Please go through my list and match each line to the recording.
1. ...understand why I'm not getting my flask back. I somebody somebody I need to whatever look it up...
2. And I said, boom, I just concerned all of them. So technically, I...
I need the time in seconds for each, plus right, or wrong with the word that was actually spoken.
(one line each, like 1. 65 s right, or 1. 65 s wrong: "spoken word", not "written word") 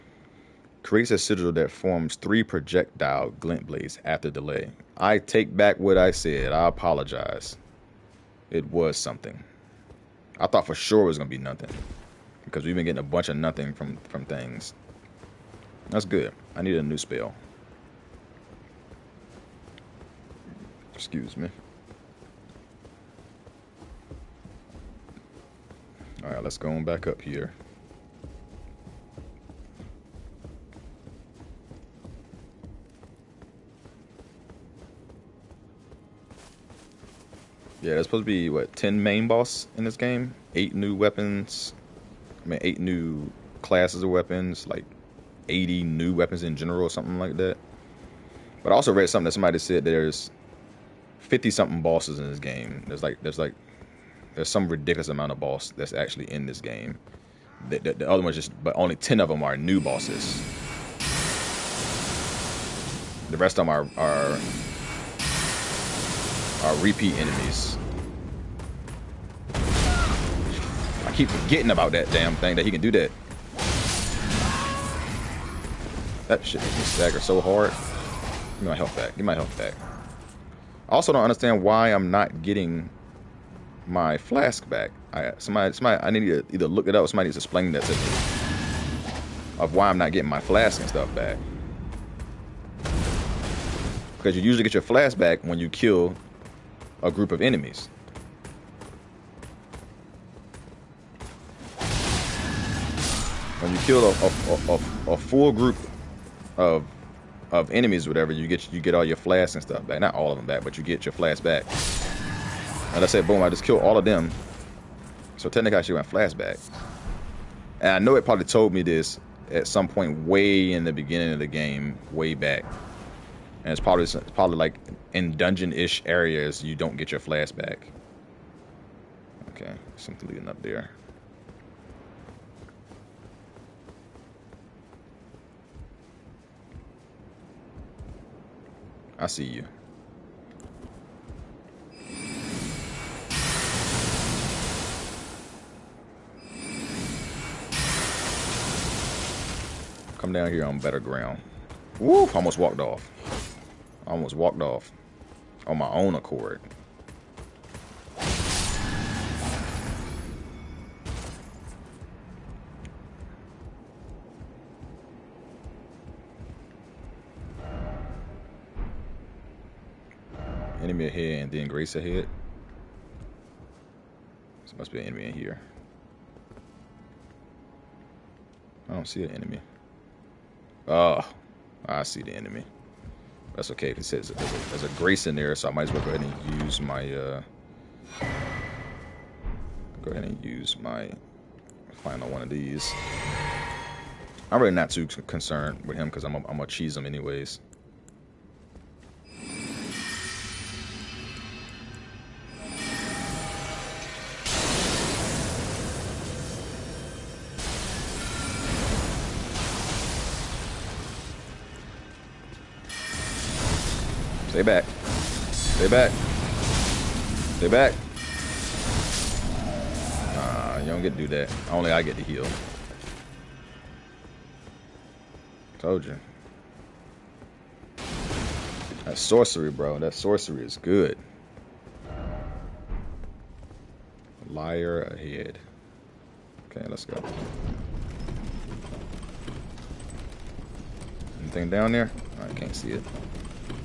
1. 81 s wrong: "either", not "whatever"
2. 112 s wrong: "killed", not "concerned".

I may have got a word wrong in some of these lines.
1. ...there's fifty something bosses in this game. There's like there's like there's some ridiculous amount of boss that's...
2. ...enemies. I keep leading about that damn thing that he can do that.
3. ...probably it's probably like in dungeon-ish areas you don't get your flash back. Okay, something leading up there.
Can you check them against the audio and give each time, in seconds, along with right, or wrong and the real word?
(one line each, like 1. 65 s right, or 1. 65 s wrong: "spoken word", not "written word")
1. 49 s right
2. 67 s wrong: "forgetting", not "leading"
3. 123 s right.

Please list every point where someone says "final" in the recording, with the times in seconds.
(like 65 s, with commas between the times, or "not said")
192 s.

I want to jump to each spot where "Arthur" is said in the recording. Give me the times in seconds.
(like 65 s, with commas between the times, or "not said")
not said.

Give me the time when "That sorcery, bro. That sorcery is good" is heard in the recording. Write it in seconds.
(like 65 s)
229 s.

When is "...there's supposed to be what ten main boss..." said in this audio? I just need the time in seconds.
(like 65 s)
37 s.